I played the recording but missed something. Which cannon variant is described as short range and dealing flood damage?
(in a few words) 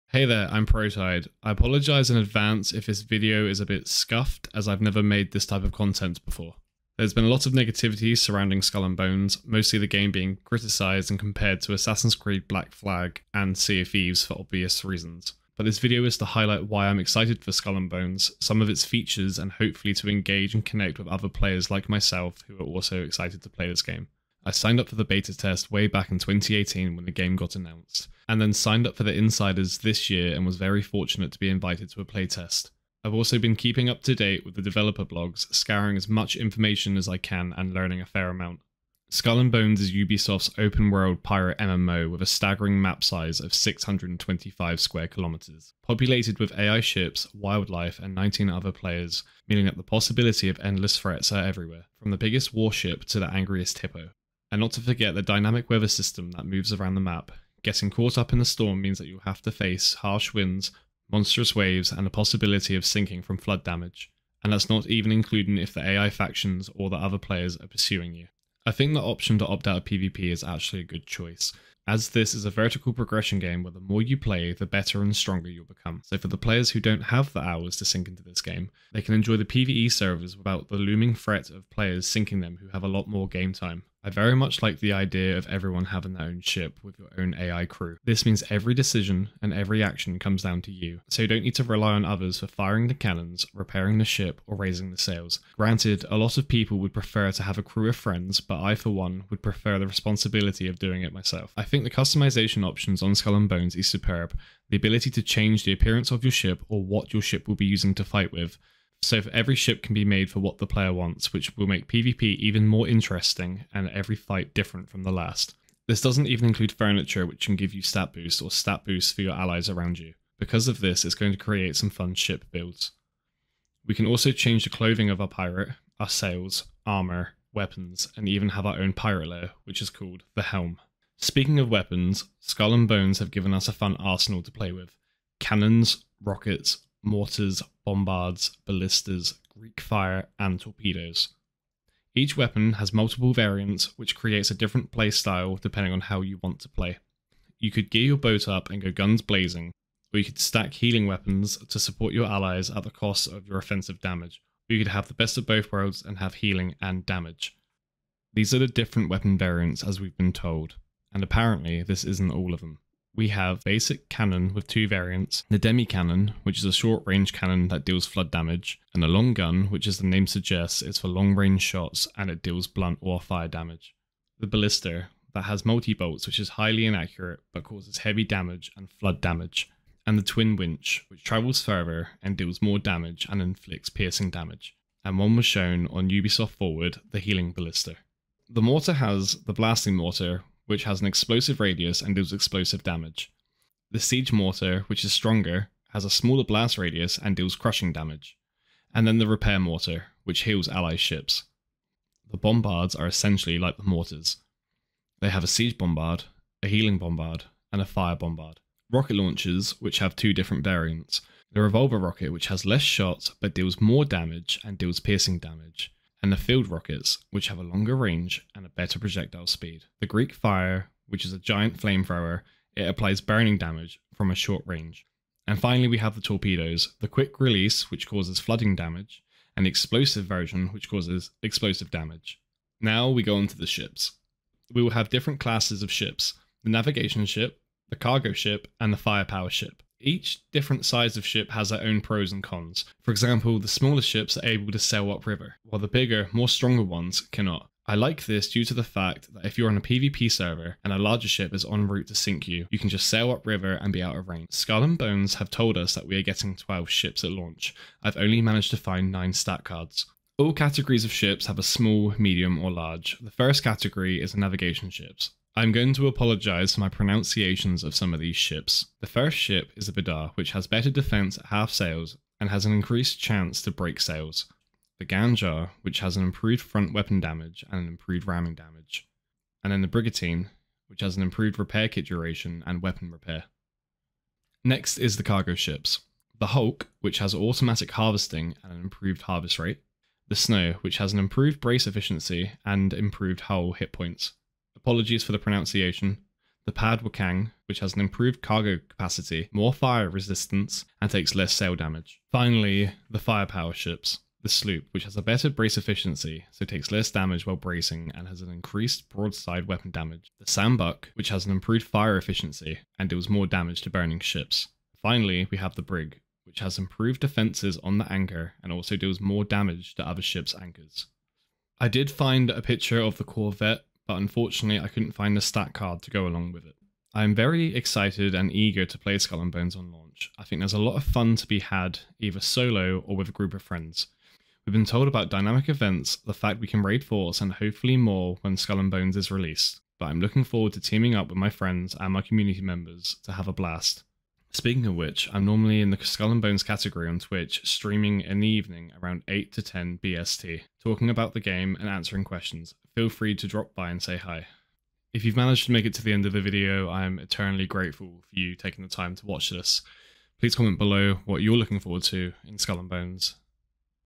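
demi cannon.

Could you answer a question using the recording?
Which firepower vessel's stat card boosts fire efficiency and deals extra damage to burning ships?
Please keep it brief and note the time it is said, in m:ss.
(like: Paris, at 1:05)
sambuk, at 5:10.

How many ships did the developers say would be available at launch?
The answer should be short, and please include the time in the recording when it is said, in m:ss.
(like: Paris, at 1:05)
12, at 4:16.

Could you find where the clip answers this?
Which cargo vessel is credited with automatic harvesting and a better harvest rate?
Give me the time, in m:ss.
4:46.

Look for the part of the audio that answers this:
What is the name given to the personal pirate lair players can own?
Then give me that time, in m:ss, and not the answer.
2:10.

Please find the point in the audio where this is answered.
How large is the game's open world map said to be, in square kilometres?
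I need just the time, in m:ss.
0:43.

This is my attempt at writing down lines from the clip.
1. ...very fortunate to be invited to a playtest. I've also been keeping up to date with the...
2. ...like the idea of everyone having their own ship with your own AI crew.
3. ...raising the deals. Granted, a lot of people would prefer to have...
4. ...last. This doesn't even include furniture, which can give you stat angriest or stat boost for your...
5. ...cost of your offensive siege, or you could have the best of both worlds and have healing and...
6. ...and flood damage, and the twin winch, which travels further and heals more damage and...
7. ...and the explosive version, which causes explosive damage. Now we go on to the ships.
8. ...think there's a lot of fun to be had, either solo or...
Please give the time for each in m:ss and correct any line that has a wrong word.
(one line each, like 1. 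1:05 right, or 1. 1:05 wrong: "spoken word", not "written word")
1. 0:30 right
2. 1:24 right
3. 1:34 wrong: "sails", not "deals"
4. 1:55 wrong: "boost", not "angriest"
5. 2:32 wrong: "damage", not "siege"
6. 2:58 wrong: "deals", not "heals"
7. 3:49 right
8. 5:30 right.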